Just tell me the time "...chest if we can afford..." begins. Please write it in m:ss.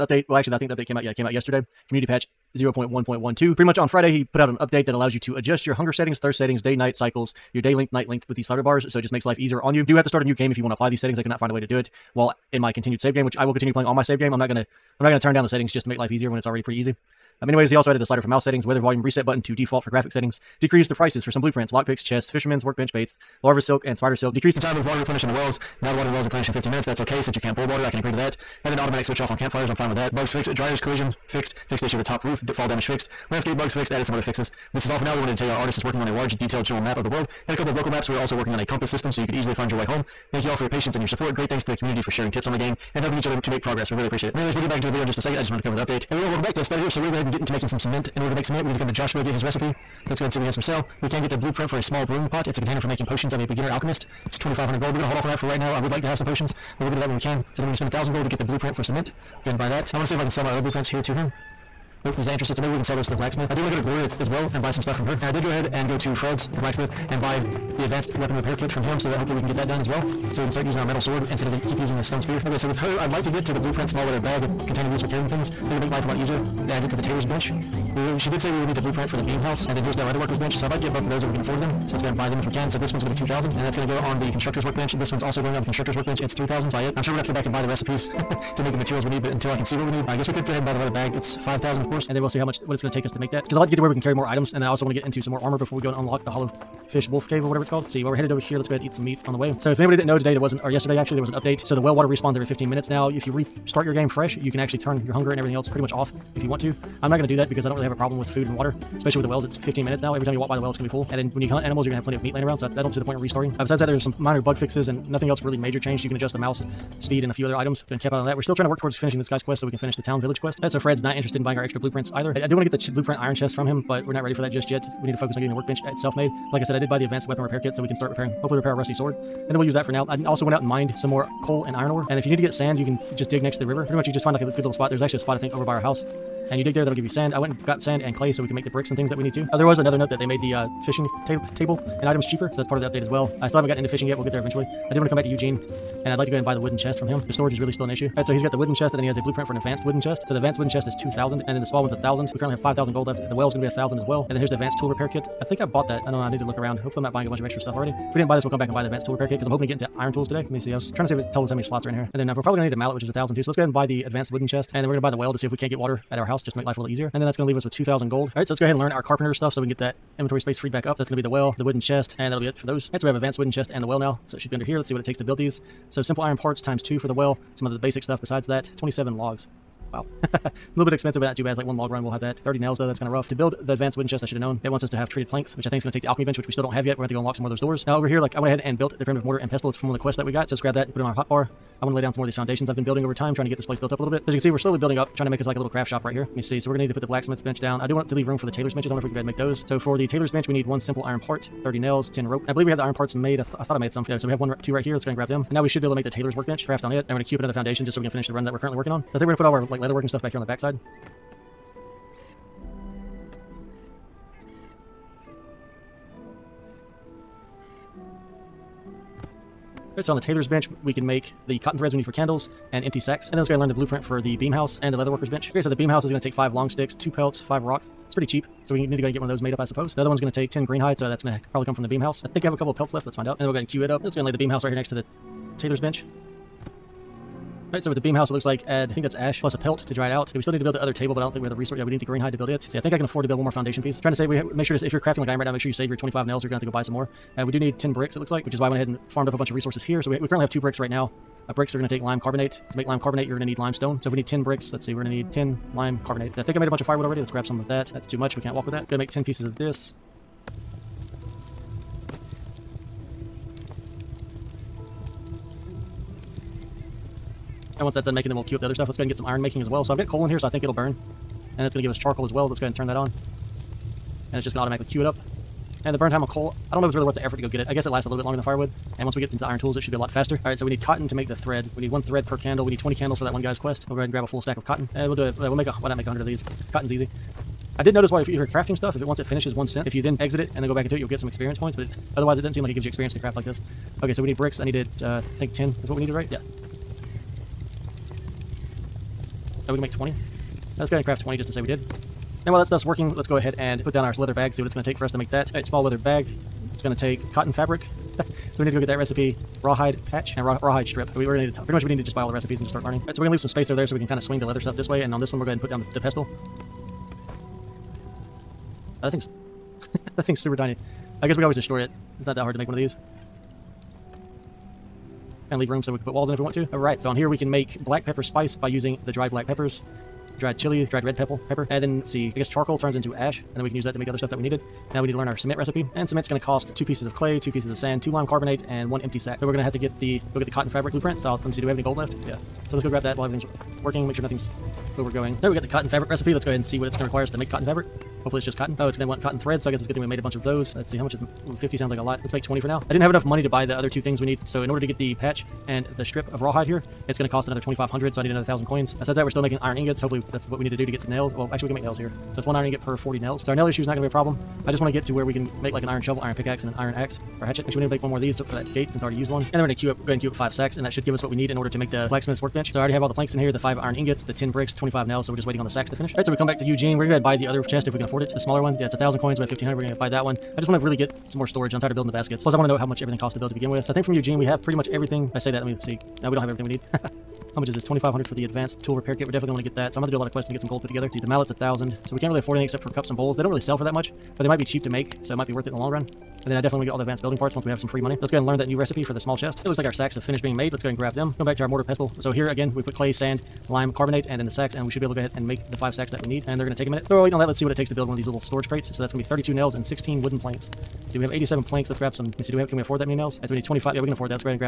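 6:17.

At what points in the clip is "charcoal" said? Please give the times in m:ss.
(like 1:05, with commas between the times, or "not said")
4:31, 5:32.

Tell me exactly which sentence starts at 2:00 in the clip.
That's so Fred's not interested in buying our extra blueprints either.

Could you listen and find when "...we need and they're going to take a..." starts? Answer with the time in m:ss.
6:46.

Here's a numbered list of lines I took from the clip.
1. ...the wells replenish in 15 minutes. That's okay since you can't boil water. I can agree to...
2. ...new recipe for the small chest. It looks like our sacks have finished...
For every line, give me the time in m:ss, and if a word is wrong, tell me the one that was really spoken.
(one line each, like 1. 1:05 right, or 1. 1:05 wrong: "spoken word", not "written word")
1. 0:26 right
2. 6:38 right.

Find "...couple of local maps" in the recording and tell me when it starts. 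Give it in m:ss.
0:37.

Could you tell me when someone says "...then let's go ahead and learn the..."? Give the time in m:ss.
3:43.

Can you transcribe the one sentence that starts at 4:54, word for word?
I needed, uh, I think 10 is what we needed, right?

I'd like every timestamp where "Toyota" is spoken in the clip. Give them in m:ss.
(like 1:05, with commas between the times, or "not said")
not said.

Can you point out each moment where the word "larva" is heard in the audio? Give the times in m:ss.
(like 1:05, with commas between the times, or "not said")
0:23.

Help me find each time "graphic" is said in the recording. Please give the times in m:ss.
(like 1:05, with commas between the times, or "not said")
0:19.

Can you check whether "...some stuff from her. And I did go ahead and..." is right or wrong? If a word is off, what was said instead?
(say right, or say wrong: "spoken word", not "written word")
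right.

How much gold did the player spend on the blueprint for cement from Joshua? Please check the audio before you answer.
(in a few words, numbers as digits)
1,000.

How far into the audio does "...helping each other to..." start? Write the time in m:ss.
0:43.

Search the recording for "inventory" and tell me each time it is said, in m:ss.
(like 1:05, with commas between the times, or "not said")
2:50.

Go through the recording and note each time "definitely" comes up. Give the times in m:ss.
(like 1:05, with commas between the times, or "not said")
6:29, 6:36.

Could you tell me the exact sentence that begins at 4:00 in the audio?
we still need to build the other table, but I don't think we have the resource.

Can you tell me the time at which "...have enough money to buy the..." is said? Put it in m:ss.
5:53.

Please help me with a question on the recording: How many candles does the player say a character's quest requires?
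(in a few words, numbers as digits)
20.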